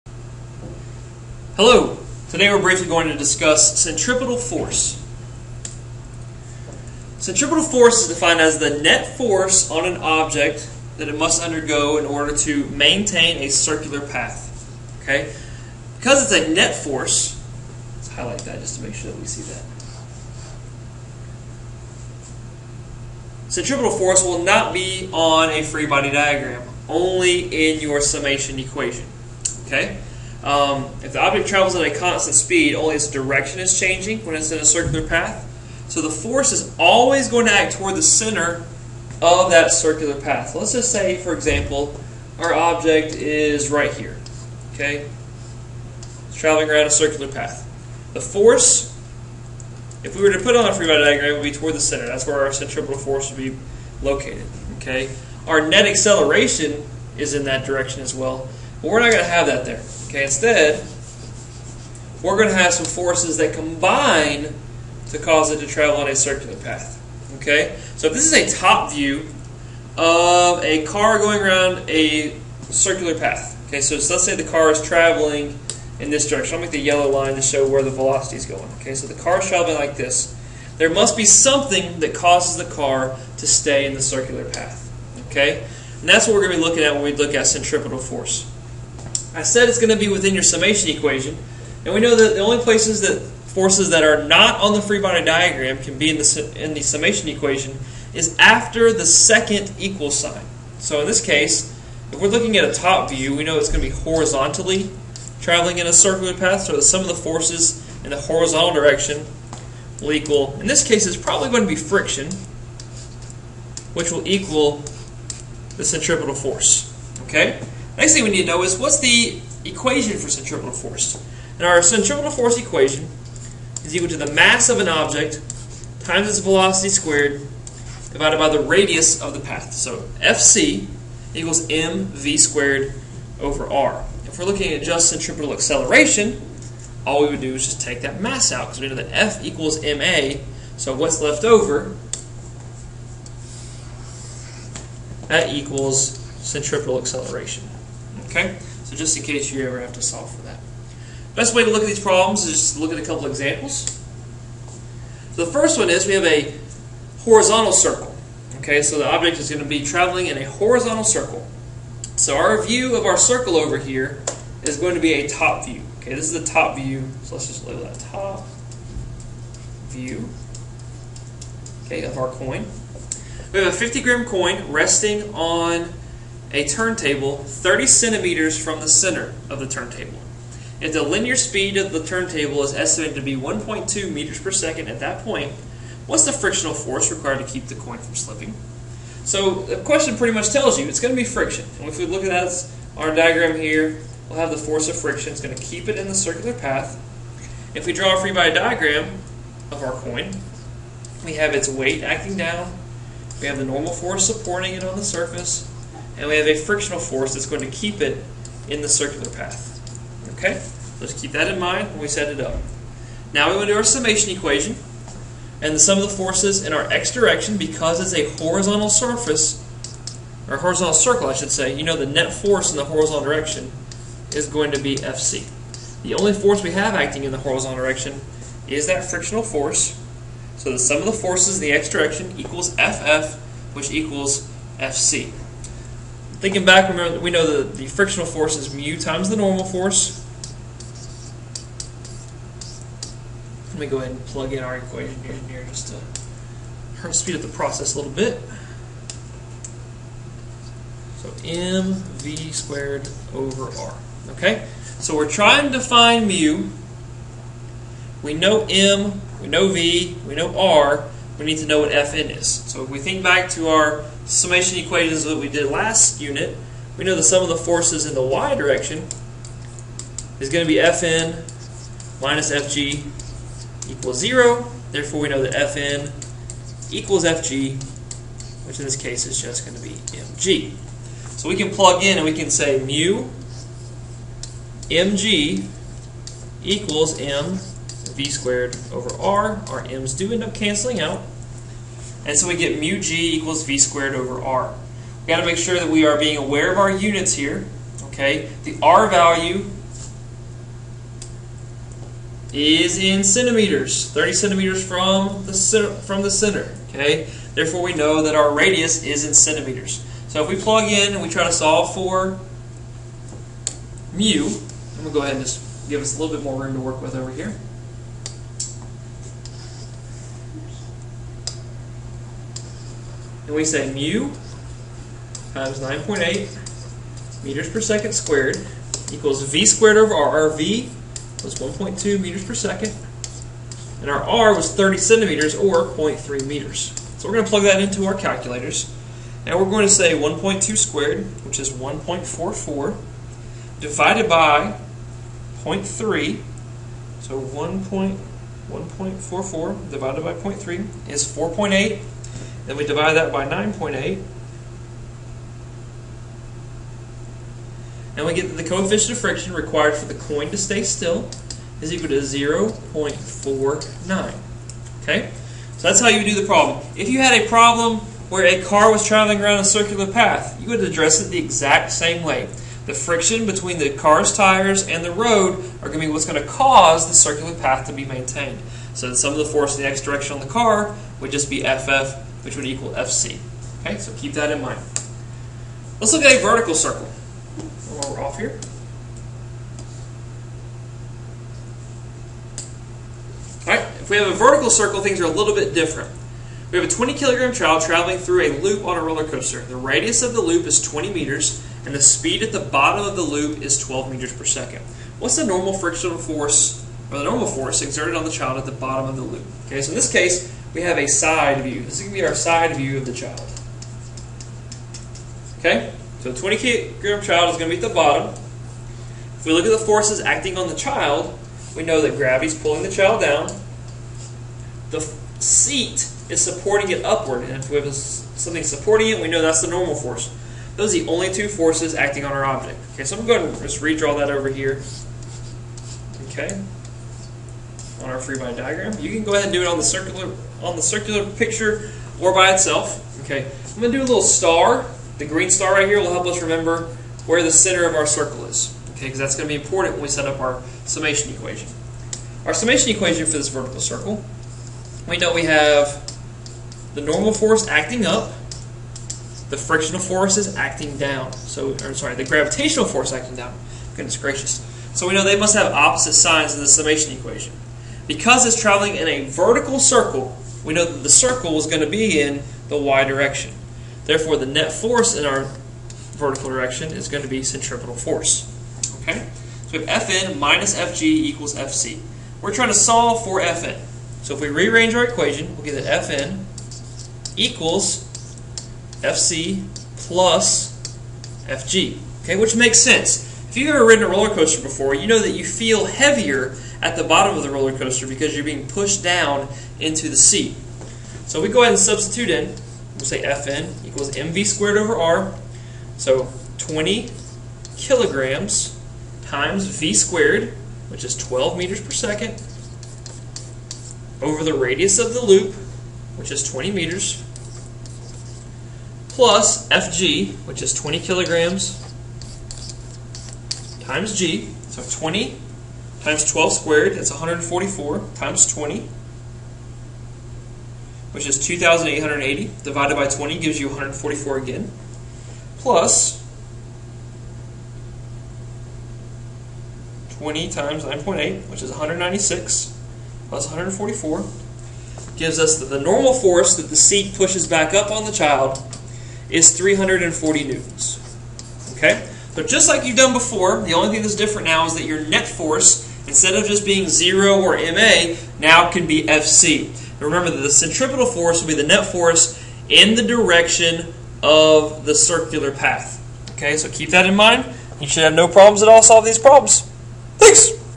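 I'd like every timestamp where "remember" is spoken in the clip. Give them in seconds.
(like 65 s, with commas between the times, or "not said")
236 s, 446 s, 560 s.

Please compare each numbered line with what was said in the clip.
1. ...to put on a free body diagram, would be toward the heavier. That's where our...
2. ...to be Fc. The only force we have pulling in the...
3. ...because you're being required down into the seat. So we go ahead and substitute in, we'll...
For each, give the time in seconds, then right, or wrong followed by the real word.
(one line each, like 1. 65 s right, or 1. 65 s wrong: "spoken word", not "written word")
1. 50 s wrong: "center", not "heavier"
2. 224 s wrong: "acting", not "pulling"
3. 498 s wrong: "pushed", not "required".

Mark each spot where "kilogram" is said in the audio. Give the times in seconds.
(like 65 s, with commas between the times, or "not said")
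397 s, 416 s, 507 s, 520 s.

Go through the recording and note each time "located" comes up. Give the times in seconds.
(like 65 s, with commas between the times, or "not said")
54 s.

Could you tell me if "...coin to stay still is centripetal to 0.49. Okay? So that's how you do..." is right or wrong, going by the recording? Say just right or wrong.
wrong.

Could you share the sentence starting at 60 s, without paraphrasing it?
Okay, instead, we're going to have some forces that combine to cause it to travel on a circular path.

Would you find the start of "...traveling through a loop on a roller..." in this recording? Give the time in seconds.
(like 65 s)
397 s.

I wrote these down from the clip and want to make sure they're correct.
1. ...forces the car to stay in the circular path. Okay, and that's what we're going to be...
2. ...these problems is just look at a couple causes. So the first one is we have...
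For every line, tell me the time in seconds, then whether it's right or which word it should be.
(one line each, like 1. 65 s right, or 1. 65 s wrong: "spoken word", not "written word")
1. 82 s wrong: "causes", not "forces"
2. 151 s wrong: "examples", not "causes".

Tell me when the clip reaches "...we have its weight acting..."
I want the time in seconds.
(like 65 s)
201 s.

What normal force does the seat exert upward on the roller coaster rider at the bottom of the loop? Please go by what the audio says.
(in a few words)
340 newtons.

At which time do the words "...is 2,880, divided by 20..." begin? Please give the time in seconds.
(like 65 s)
531 s.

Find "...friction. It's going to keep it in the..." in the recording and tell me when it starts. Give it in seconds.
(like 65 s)
194 s.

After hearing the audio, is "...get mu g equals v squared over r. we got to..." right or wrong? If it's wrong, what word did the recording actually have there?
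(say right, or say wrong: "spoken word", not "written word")
right.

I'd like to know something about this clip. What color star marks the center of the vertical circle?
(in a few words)
Green.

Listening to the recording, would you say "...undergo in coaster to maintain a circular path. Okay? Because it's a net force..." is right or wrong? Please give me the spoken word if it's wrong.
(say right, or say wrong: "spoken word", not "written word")
wrong: "order", not "coaster".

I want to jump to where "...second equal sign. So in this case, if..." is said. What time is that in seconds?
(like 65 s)
99 s.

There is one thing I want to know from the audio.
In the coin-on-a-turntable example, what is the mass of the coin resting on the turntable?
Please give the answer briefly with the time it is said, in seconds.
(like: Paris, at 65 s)
50 grams, at 173 s.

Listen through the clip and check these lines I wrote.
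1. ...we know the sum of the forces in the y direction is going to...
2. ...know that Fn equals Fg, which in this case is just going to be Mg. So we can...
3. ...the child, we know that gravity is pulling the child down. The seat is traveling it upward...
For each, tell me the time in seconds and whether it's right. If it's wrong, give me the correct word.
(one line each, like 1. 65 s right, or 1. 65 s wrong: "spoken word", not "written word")
1. 266 s right
2. 275 s right
3. 420 s wrong: "supporting", not "traveling".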